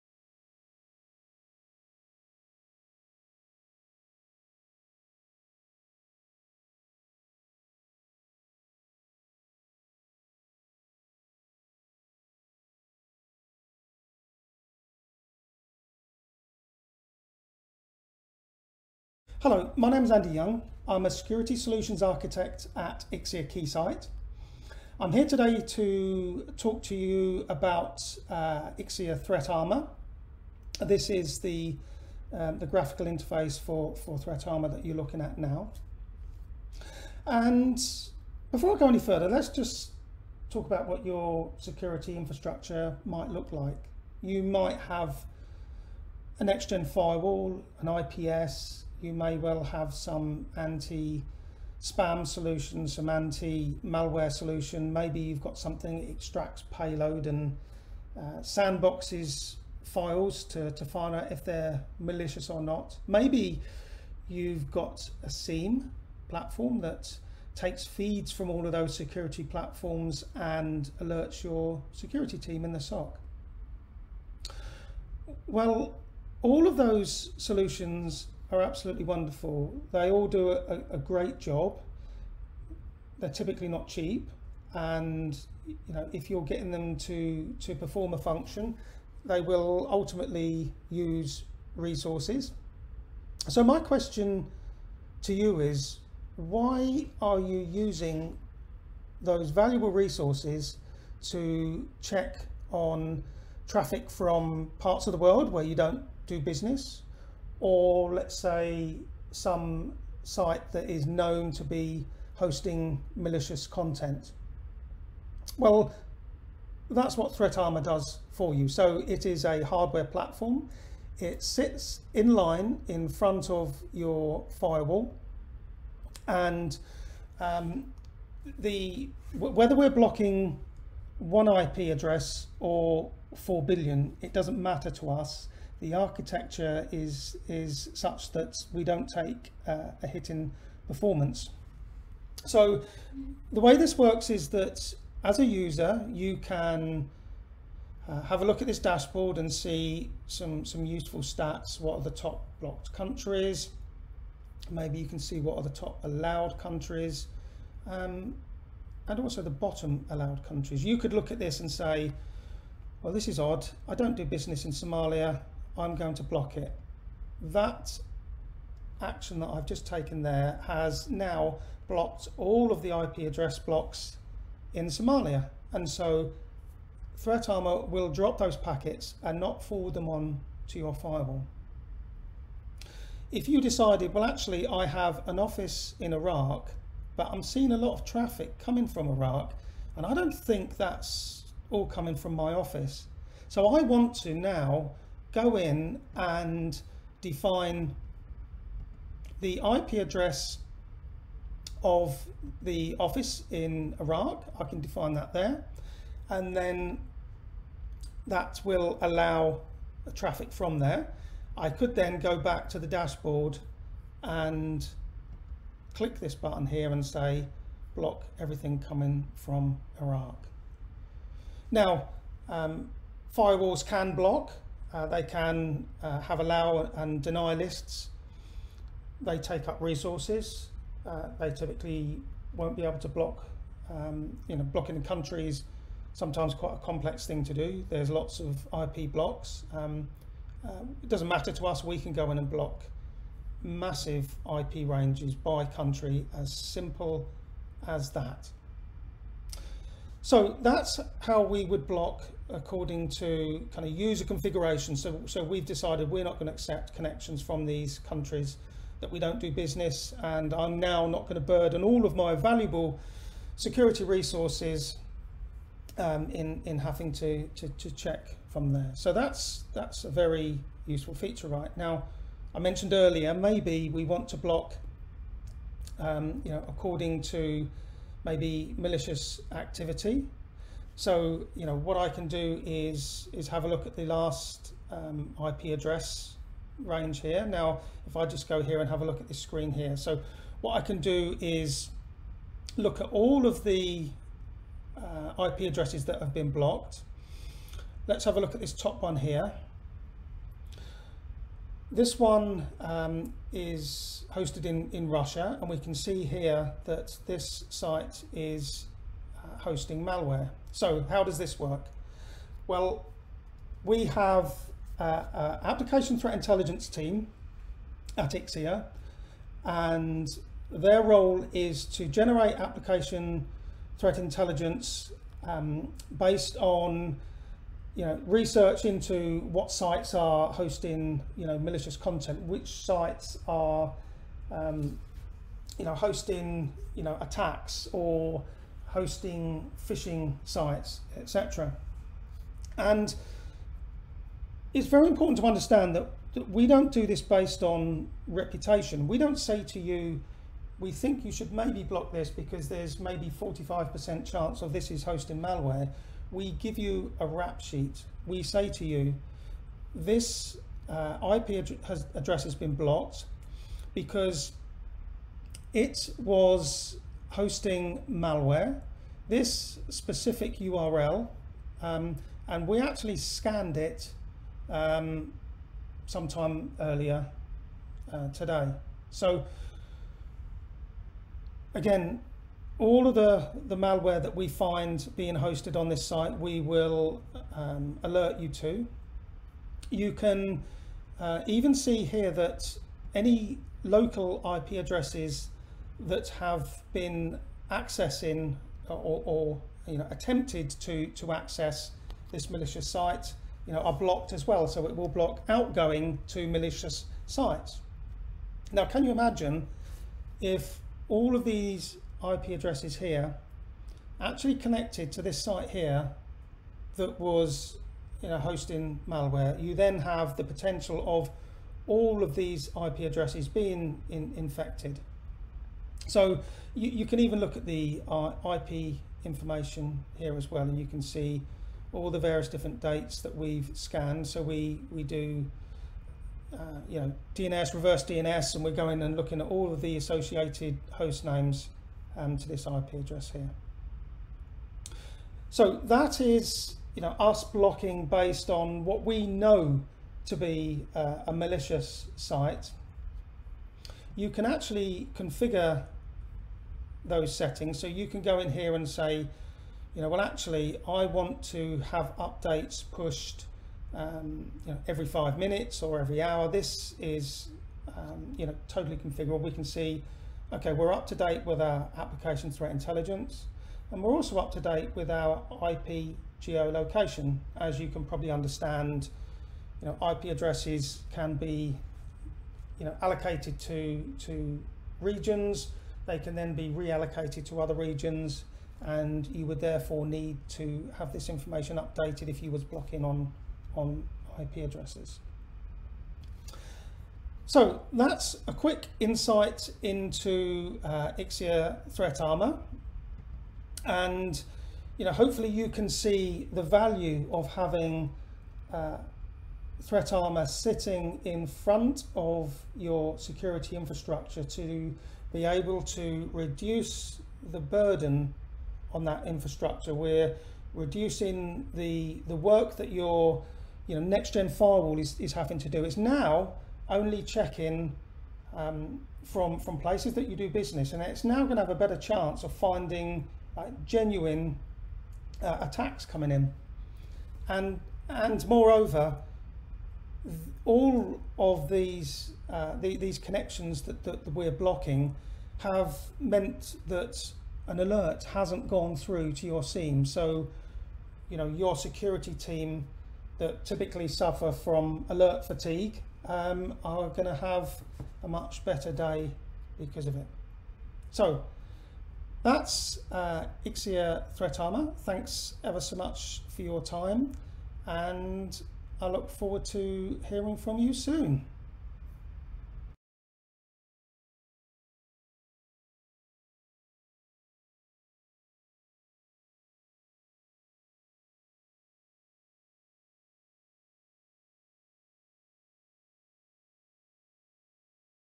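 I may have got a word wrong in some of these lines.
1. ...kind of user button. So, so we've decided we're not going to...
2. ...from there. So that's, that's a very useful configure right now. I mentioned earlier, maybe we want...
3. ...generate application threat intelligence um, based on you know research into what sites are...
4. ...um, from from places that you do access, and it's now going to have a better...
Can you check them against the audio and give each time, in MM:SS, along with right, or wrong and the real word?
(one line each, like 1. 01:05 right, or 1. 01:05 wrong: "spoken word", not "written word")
1. 04:13 wrong: "configuration", not "button"
2. 04:28 wrong: "feature", not "configure"
3. 05:22 right
4. 08:48 wrong: "business", not "access".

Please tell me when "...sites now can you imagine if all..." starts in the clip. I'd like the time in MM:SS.
06:47.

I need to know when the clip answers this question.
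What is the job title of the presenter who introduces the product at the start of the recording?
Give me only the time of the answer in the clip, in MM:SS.
00:21.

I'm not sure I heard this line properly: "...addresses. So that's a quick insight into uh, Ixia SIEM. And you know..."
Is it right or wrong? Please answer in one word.
wrong.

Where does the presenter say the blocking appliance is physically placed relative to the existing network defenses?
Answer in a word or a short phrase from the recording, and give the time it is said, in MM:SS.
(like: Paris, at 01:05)
In front of your firewall, at 02:02.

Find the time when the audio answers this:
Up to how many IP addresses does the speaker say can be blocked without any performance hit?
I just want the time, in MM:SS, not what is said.
02:13.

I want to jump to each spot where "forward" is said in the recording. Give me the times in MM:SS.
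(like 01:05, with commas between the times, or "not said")
02:59, 09:29.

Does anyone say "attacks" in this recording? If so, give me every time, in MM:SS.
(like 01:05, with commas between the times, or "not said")
05:37, 08:55.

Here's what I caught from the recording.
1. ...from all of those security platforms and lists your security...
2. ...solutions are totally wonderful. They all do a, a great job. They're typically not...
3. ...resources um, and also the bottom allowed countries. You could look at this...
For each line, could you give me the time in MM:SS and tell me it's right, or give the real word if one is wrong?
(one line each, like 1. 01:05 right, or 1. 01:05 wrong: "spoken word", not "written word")
1. 01:08 wrong: "alerts", not "lists"
2. 01:17 wrong: "absolutely", not "totally"
3. 02:36 wrong: "countries", not "resources".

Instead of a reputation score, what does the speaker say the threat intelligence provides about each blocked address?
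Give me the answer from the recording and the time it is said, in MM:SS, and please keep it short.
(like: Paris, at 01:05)
A rap sheet, at 05:57.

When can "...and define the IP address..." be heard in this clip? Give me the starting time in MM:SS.
03:16.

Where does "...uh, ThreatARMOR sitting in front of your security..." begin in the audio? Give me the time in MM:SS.
08:28.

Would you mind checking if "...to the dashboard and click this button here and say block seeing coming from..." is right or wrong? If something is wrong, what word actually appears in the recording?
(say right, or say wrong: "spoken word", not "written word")
wrong: "everything", not "seeing".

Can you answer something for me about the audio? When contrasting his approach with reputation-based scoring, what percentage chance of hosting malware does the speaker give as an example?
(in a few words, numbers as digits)
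45%.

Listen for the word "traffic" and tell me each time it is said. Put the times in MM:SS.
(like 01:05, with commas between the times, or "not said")
01:43, 03:08, 03:30.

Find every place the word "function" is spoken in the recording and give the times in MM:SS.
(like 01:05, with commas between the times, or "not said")
01:28.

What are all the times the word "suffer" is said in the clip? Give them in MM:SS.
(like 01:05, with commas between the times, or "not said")
09:14.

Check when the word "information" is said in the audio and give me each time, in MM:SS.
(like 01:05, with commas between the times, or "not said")
07:09, 08:11.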